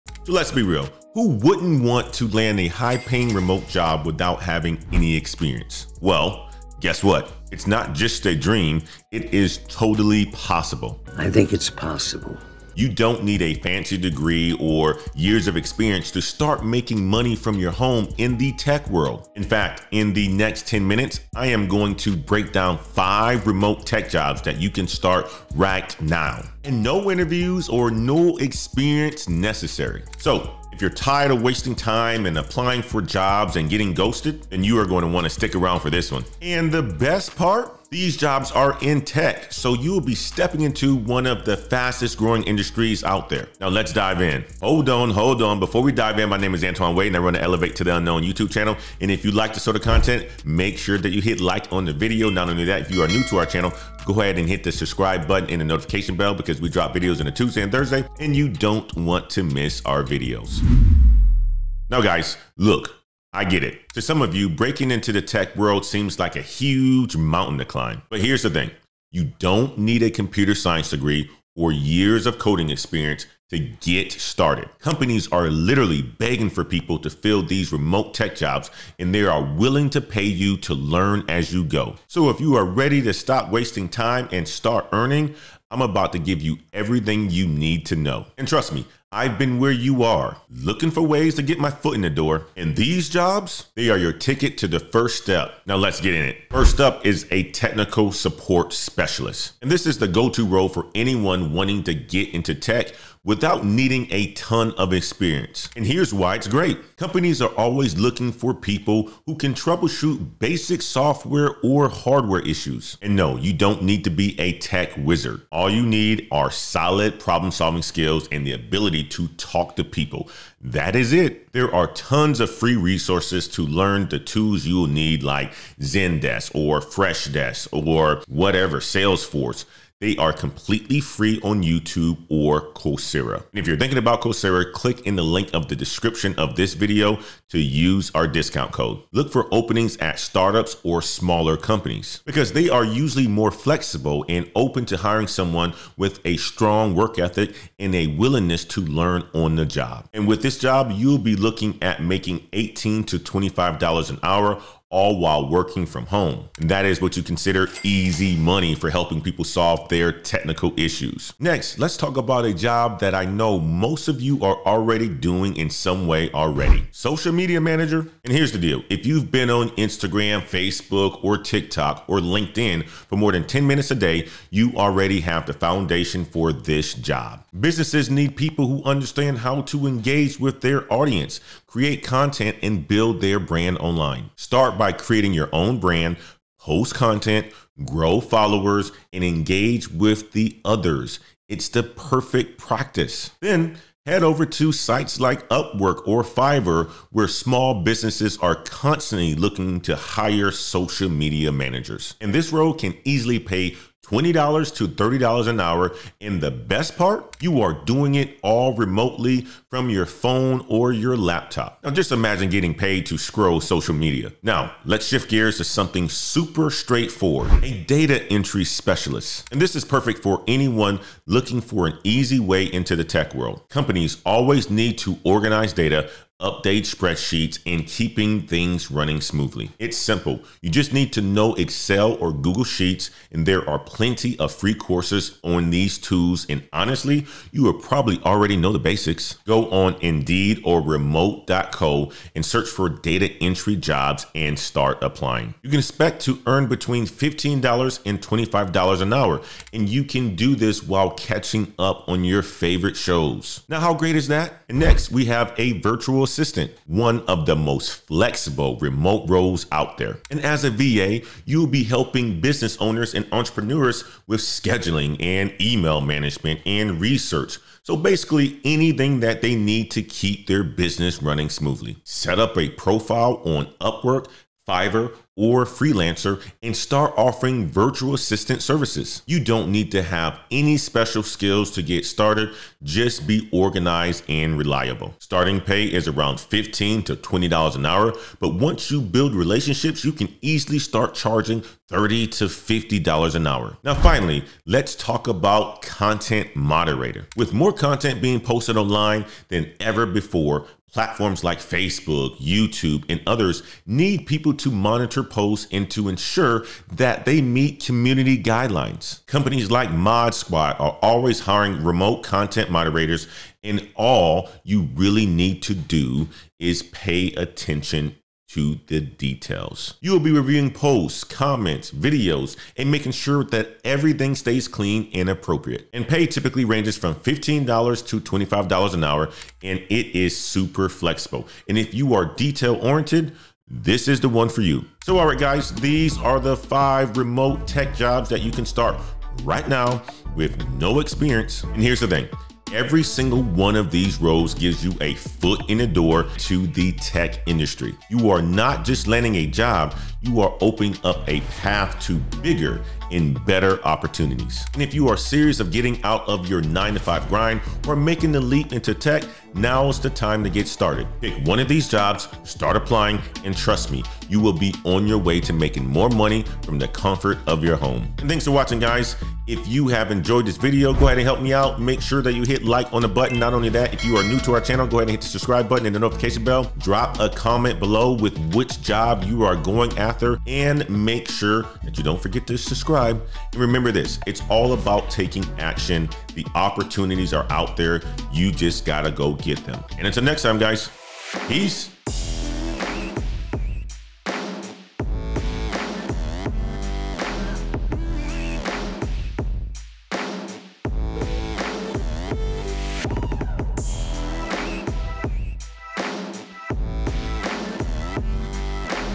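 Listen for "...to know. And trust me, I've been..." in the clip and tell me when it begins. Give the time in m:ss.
1:27.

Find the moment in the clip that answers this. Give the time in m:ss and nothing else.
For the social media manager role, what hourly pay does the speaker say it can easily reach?
3:24.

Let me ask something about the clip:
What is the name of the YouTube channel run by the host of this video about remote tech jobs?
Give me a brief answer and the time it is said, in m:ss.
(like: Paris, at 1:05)
Elevate to the Unknown, at 0:47.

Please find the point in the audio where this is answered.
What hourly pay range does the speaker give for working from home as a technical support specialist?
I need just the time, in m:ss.
2:32.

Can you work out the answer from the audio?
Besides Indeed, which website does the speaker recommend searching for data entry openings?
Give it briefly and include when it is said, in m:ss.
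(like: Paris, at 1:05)
remote.co, at 4:00.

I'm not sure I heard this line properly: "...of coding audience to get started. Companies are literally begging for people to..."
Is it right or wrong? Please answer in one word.
wrong.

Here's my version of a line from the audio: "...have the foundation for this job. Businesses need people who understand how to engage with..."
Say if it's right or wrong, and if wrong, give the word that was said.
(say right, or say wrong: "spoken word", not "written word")
right.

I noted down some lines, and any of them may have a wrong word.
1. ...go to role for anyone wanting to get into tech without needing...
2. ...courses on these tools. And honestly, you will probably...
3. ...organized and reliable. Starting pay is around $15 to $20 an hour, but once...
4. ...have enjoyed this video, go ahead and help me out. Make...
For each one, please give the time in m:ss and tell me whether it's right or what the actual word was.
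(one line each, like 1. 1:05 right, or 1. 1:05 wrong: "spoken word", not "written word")
1. 1:40 right
2. 3:54 right
3. 4:43 right
4. 6:09 right.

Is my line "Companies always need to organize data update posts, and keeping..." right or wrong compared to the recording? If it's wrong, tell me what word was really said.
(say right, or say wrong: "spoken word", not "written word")
wrong: "spreadsheets", not "posts".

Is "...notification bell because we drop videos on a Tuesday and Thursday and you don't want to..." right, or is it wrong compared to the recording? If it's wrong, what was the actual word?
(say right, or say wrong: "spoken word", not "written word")
right.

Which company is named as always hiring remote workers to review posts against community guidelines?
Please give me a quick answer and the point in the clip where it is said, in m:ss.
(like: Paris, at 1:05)
ModSquad, at 5:09.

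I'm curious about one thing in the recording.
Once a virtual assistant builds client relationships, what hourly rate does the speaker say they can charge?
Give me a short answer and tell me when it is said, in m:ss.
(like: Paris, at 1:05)
$30 to $50 an hour, at 4:51.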